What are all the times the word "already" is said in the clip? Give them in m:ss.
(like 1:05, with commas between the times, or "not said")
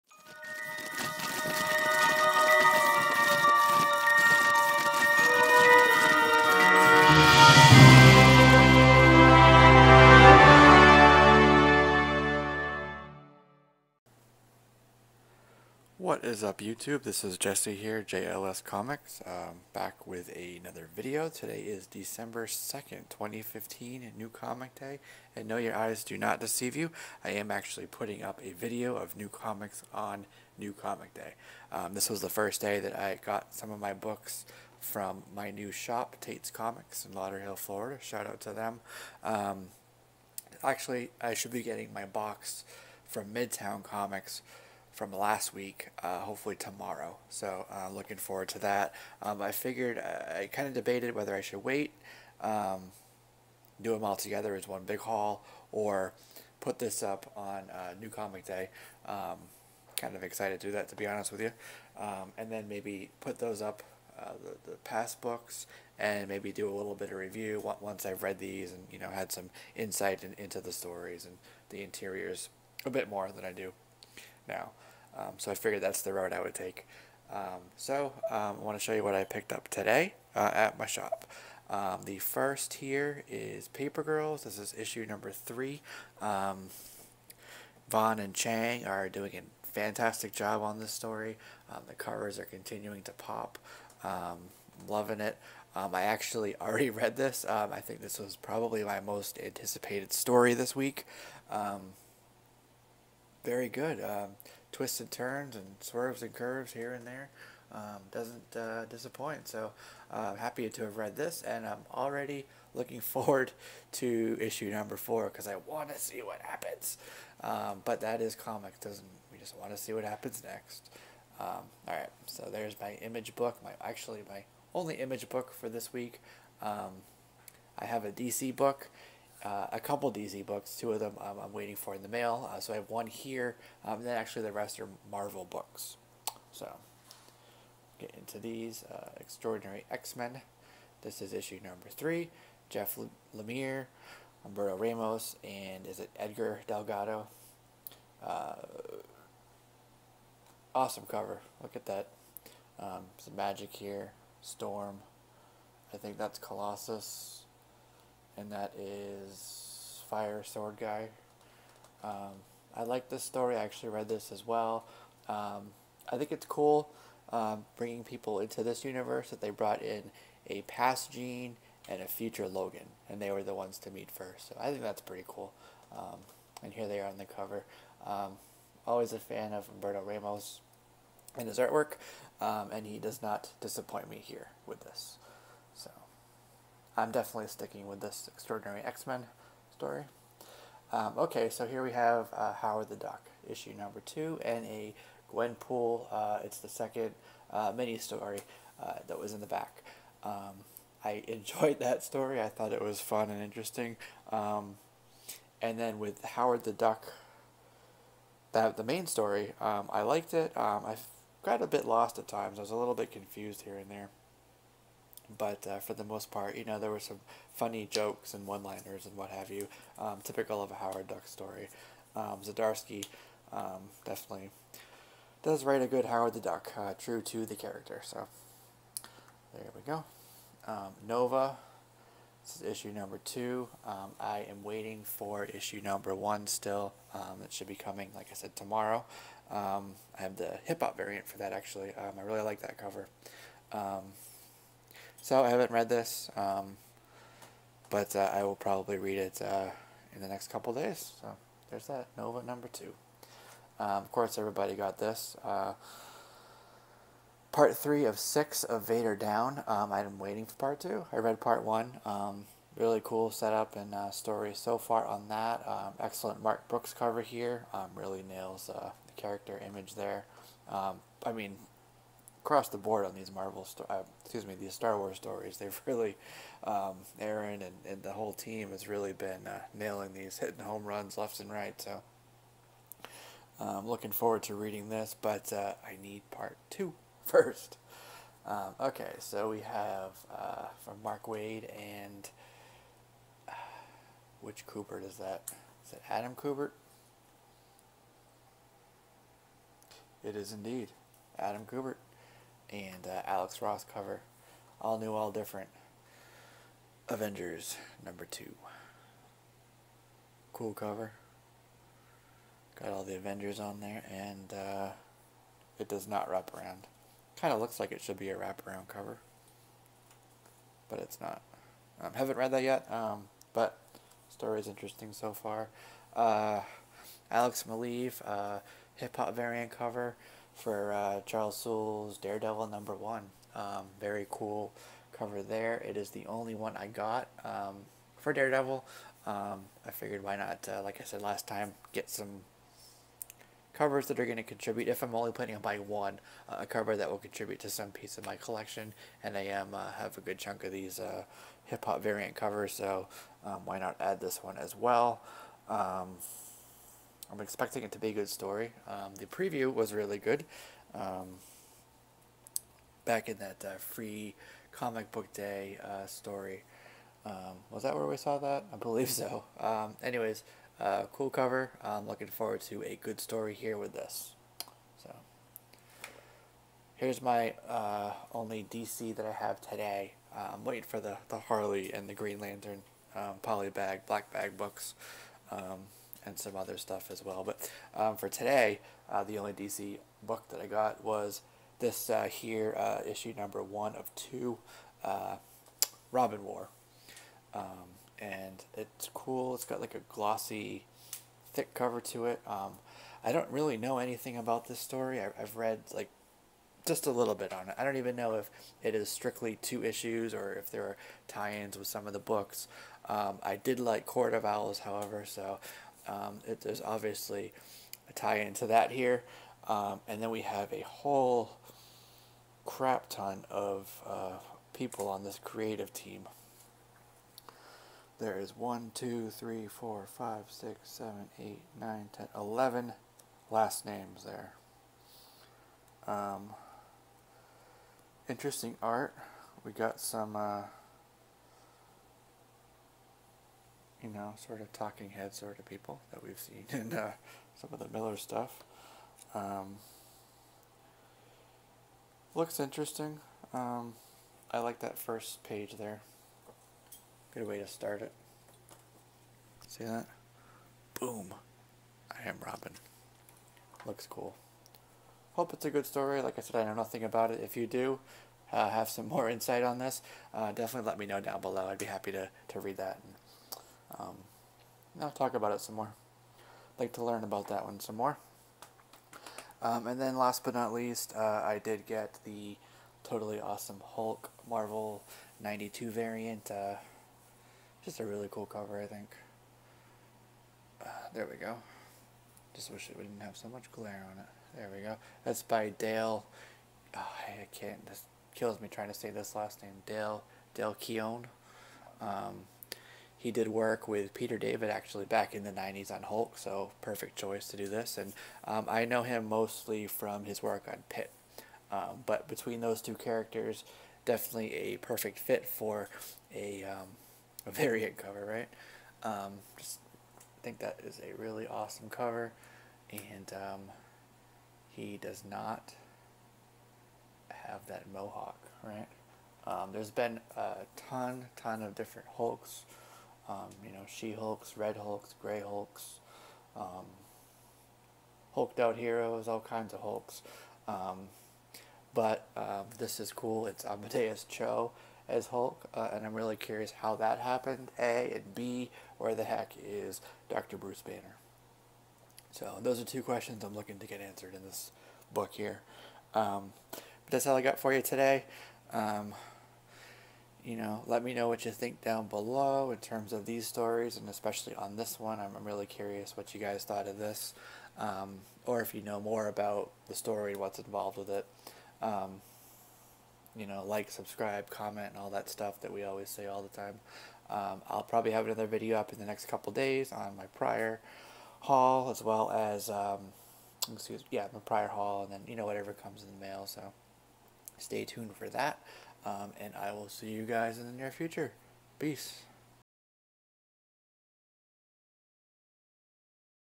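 1:36, 1:51.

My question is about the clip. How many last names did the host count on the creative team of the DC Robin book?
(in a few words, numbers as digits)
11.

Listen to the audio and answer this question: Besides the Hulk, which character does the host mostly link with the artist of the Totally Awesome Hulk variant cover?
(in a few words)
Pitt.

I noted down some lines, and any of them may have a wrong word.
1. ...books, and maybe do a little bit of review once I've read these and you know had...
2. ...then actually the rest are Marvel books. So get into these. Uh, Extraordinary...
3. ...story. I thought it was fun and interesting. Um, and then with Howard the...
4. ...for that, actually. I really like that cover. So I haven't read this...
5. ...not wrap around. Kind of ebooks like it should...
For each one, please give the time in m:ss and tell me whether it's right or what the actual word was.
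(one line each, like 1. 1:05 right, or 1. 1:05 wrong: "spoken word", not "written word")
1. 1:05 right
2. 2:14 right
3. 3:22 right
4. 4:01 right
5. 5:16 wrong: "looks", not "ebooks".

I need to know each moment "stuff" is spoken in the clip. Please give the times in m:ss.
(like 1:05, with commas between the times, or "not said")
6:26, 7:28, 9:35.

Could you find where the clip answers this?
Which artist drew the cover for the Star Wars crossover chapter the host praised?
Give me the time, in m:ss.
4:26.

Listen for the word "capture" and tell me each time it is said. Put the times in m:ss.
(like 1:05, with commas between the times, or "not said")
not said.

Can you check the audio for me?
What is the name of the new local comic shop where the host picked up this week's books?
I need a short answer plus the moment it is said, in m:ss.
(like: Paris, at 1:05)
Tate's Comics, at 0:36.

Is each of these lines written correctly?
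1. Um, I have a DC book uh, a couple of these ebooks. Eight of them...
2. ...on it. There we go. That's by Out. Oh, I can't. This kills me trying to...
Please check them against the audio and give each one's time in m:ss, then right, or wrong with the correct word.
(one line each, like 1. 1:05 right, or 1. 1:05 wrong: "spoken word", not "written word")
1. 2:06 wrong: "Two", not "Eight"
2. 8:14 wrong: "Dale", not "Out".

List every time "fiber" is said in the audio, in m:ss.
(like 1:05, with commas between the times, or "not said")
not said.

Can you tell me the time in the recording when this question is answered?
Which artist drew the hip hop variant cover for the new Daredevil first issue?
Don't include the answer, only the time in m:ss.
5:27.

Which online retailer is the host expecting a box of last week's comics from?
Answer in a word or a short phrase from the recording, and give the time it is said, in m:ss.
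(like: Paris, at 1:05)
Midtown Comics, at 0:43.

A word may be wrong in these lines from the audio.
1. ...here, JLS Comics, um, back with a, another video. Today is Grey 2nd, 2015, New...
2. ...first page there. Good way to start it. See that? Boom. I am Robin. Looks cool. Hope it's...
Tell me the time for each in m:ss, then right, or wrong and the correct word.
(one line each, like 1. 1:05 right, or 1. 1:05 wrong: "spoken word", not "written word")
1. 0:17 wrong: "December", not "Grey"
2. 7:34 right.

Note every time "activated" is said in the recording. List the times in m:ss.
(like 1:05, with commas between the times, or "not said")
not said.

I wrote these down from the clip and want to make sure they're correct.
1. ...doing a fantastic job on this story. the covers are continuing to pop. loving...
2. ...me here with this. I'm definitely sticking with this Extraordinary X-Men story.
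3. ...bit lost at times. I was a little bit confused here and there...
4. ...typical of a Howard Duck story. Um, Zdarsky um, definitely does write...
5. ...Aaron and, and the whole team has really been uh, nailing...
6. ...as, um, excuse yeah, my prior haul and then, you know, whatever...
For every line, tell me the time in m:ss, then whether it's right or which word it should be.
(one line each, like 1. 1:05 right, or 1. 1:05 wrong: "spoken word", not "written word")
1. 1:29 right
2. 3:04 right
3. 3:31 right
4. 3:40 right
5. 4:37 right
6. 9:42 right.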